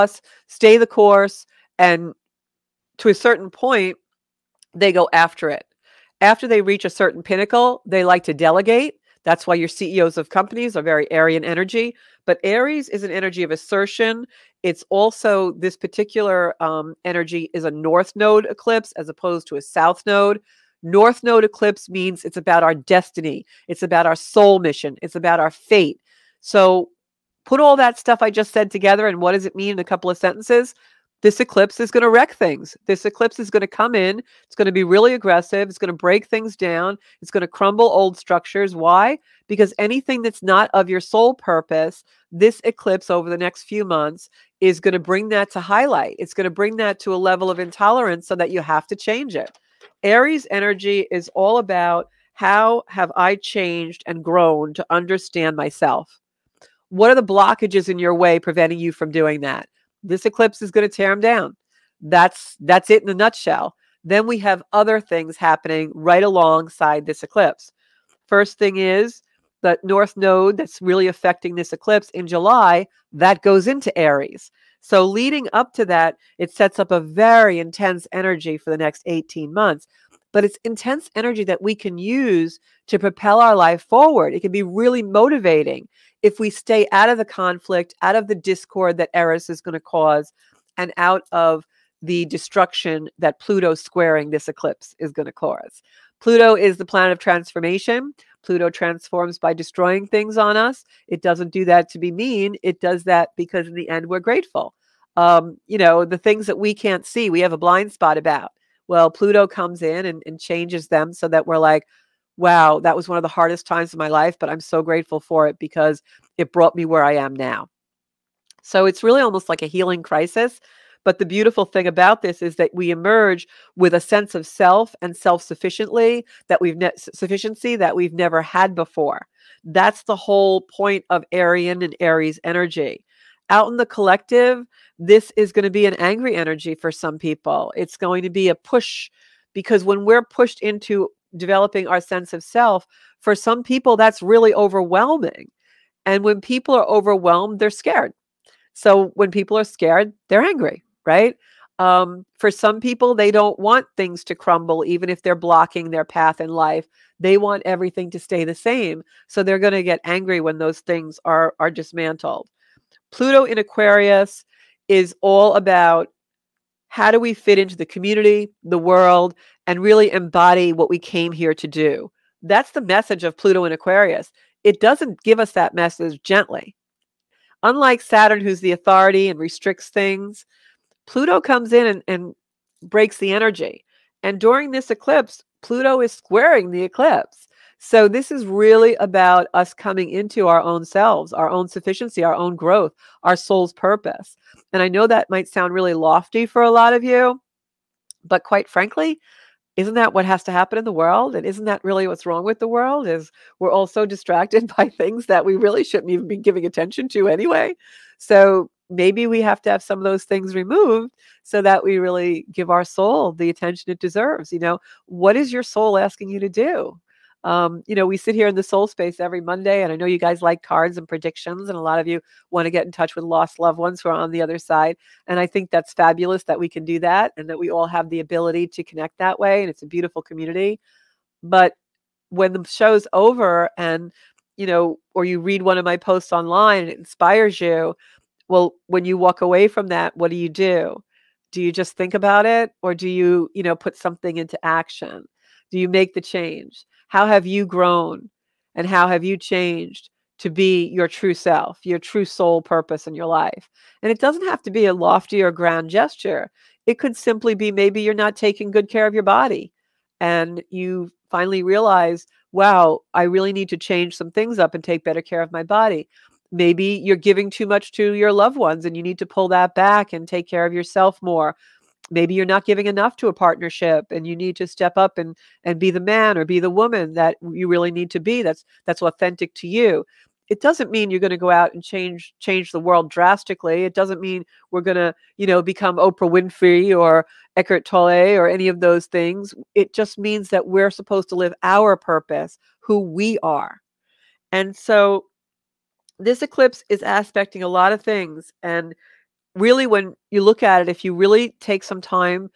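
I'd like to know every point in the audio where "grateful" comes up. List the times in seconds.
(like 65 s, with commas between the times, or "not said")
104 s, 114 s.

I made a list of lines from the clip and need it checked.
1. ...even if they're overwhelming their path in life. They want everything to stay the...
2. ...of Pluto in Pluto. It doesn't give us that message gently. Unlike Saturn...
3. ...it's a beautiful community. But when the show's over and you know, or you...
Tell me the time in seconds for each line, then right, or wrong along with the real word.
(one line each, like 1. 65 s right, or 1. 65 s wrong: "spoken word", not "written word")
1. 154 s wrong: "blocking", not "overwhelming"
2. 173 s wrong: "Aquarius", not "Pluto"
3. 229 s right.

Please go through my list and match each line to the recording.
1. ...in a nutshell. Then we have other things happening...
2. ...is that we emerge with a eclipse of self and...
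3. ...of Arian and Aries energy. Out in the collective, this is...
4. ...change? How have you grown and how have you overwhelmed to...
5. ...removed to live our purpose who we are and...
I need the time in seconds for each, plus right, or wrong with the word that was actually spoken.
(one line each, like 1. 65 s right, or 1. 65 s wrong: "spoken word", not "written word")
1. 63 s right
2. 122 s wrong: "sense", not "eclipse"
3. 131 s right
4. 246 s wrong: "changed", not "overwhelmed"
5. 290 s wrong: "supposed", not "removed".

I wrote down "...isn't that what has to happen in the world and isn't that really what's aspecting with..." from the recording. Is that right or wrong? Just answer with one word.
wrong.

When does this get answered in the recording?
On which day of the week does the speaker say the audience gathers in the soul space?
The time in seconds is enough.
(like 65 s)
219 s.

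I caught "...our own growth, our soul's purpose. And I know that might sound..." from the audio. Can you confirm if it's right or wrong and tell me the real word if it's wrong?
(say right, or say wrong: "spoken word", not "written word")
right.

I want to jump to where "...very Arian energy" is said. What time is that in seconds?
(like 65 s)
10 s.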